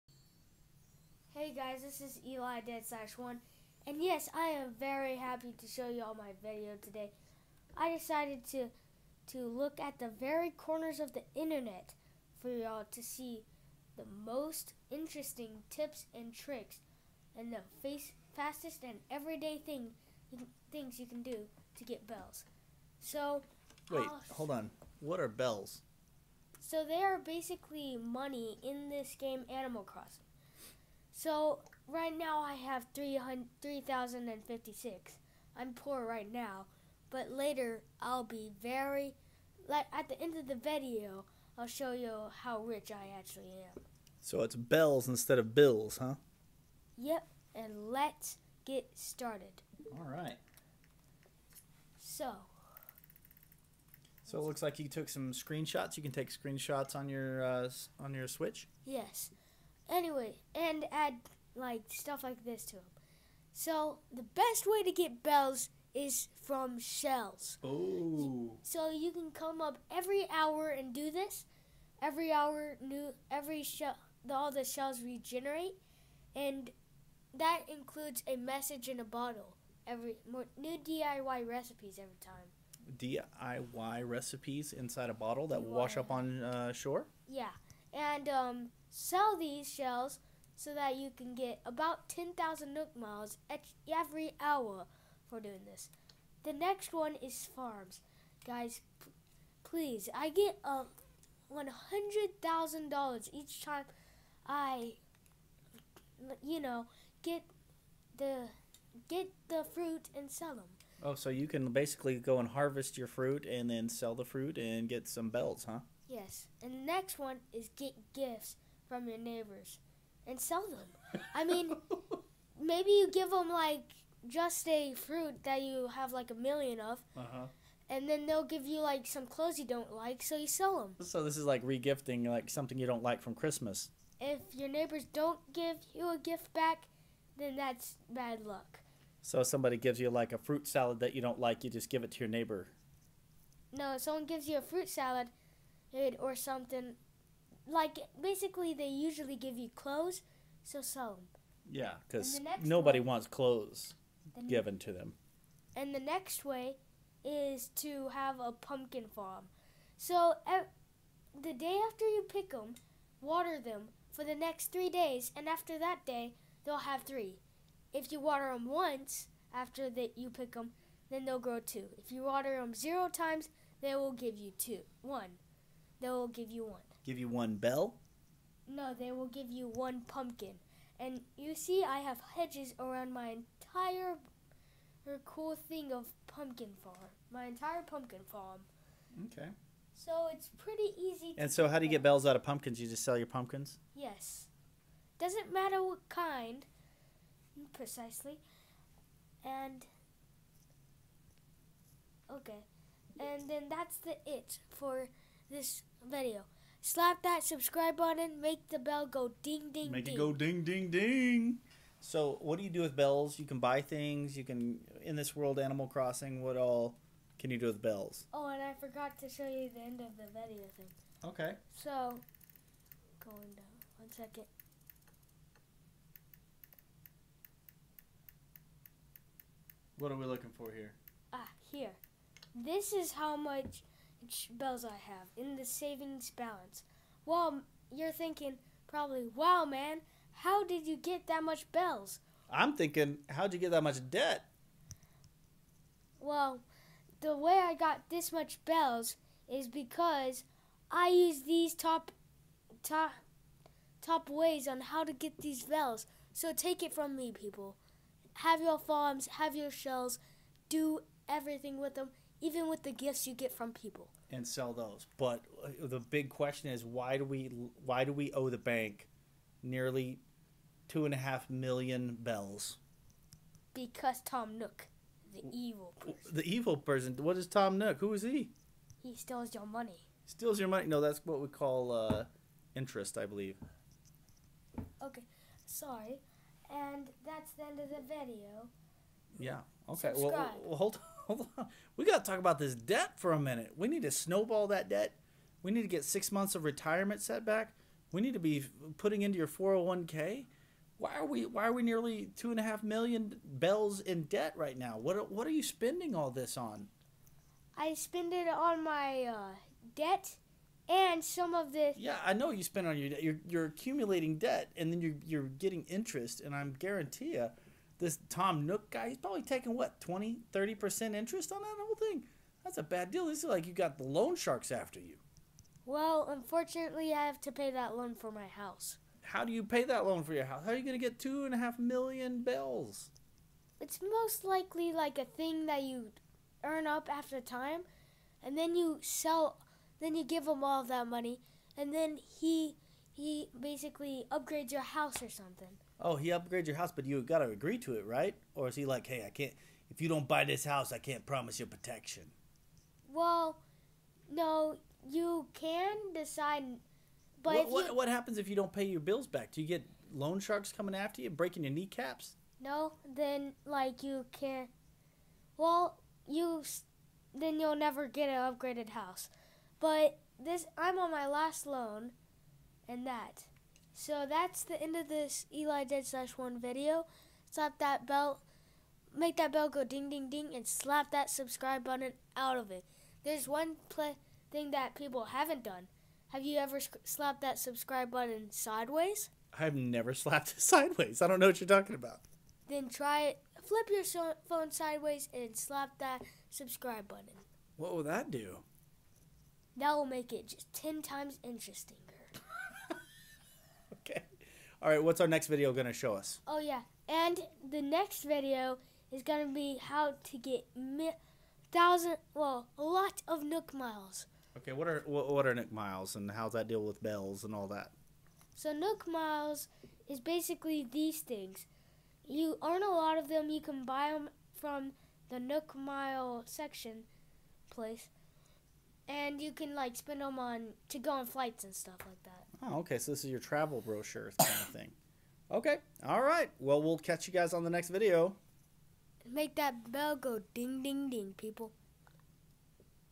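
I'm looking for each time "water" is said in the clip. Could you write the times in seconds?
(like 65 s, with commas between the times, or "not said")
163 s, 168 s, 172 s.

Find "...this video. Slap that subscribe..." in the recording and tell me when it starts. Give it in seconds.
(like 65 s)
205 s.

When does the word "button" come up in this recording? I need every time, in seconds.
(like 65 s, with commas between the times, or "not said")
207 s, 381 s, 388 s, 397 s.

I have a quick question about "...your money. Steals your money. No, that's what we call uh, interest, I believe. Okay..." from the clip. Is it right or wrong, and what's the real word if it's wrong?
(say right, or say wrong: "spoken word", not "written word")
right.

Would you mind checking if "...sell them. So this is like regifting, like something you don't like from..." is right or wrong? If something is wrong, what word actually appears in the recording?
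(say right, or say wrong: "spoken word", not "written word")
right.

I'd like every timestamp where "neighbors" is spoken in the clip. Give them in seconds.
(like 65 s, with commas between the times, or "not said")
119 s, 134 s, 142 s.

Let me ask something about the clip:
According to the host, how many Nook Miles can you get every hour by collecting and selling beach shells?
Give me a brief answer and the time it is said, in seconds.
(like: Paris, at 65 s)
10,000, at 92 s.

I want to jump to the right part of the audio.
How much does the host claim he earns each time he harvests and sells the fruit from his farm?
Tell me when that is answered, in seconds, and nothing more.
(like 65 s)
101 s.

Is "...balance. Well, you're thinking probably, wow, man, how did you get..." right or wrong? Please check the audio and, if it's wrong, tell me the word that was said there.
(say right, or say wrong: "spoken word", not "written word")
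right.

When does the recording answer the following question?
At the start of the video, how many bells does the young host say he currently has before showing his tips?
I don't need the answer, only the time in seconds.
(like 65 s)
32 s.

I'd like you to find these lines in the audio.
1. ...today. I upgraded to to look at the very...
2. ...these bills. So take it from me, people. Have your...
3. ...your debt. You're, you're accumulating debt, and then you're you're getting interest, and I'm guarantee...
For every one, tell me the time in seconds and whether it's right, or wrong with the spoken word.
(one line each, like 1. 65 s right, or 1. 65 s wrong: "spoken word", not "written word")
1. 6 s wrong: "decided", not "upgraded"
2. 255 s wrong: "bells", not "bills"
3. 312 s right.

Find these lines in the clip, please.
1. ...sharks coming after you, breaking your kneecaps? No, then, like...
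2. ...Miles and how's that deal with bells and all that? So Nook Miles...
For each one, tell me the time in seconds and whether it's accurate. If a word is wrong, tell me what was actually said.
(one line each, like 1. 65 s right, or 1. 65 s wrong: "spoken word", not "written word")
1. 360 s right
2. 415 s right.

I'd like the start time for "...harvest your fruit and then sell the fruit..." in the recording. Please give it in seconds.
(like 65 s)
112 s.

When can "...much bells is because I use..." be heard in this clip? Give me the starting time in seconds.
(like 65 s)
248 s.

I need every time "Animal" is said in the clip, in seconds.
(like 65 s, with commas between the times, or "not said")
29 s, 215 s.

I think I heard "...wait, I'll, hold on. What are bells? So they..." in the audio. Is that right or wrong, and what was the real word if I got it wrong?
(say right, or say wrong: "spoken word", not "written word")
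right.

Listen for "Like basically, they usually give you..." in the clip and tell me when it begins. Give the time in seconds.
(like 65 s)
147 s.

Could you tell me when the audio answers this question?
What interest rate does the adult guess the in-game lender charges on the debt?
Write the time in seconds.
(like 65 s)
320 s.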